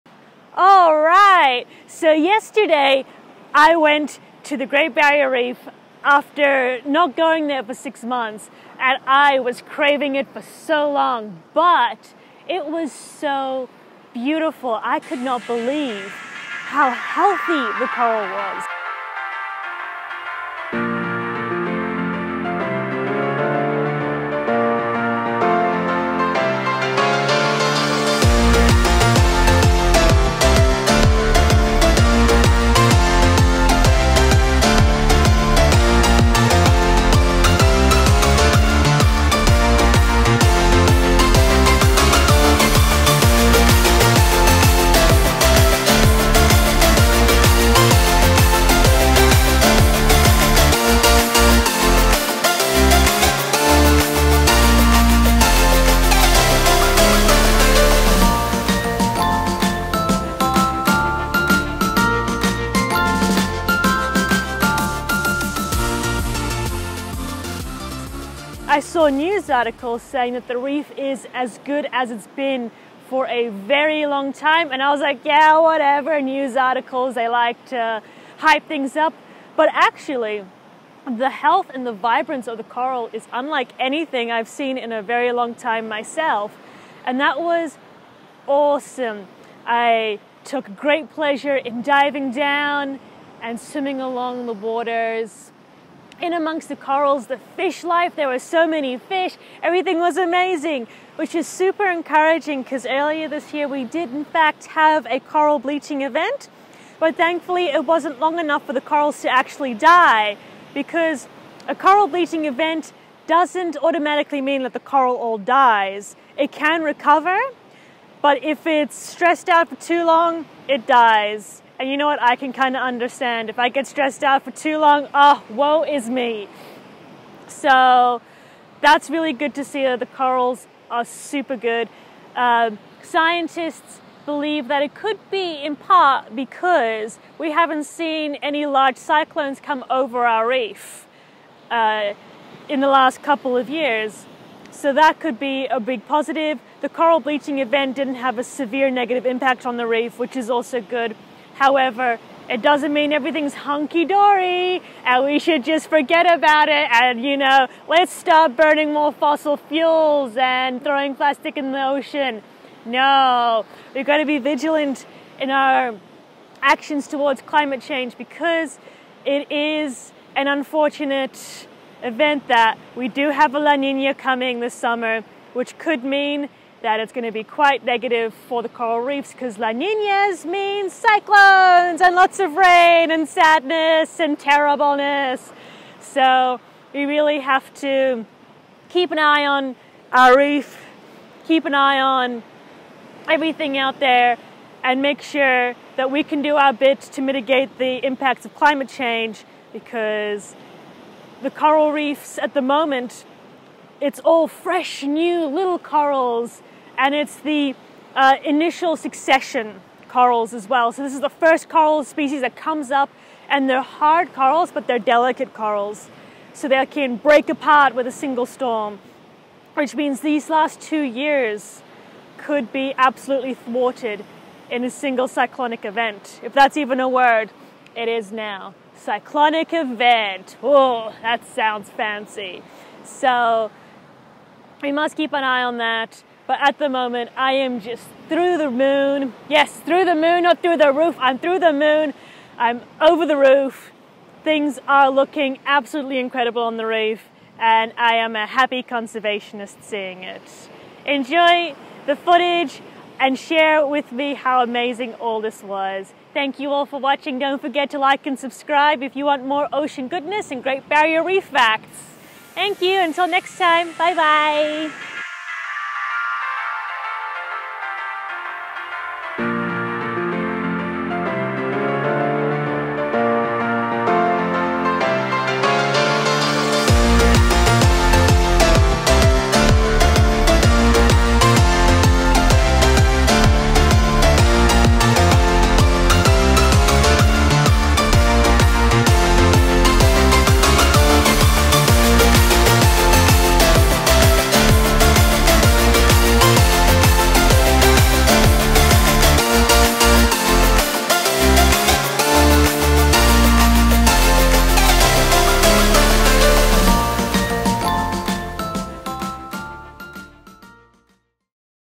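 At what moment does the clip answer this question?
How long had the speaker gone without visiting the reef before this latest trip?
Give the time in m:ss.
0:07.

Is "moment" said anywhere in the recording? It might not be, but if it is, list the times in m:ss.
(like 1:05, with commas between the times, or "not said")
3:22, 3:56.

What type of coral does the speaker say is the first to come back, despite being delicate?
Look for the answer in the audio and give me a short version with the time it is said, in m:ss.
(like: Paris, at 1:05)
hard corals, at 3:33.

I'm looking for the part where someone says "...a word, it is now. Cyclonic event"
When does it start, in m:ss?
3:46.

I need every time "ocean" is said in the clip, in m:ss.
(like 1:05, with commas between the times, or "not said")
2:41, 4:19.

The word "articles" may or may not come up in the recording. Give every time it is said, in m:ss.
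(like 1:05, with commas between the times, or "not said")
1:09, 1:16.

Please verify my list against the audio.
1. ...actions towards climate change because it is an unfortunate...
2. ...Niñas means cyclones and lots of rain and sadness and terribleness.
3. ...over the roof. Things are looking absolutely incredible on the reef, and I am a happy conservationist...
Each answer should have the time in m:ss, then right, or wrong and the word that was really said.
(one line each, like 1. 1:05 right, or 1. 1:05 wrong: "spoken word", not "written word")
1. 2:46 right
2. 2:59 right
3. 4:02 right.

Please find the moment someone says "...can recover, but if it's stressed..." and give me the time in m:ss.
1:56.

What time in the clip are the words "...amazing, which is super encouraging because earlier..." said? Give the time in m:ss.
1:40.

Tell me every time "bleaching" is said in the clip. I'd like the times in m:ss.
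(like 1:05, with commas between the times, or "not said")
1:45, 1:52, 2:27.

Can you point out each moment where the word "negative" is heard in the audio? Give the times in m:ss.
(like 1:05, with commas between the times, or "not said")
2:28, 2:57.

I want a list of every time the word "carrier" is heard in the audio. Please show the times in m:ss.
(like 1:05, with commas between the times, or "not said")
not said.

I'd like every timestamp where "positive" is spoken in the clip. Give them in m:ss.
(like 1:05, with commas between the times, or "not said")
2:26.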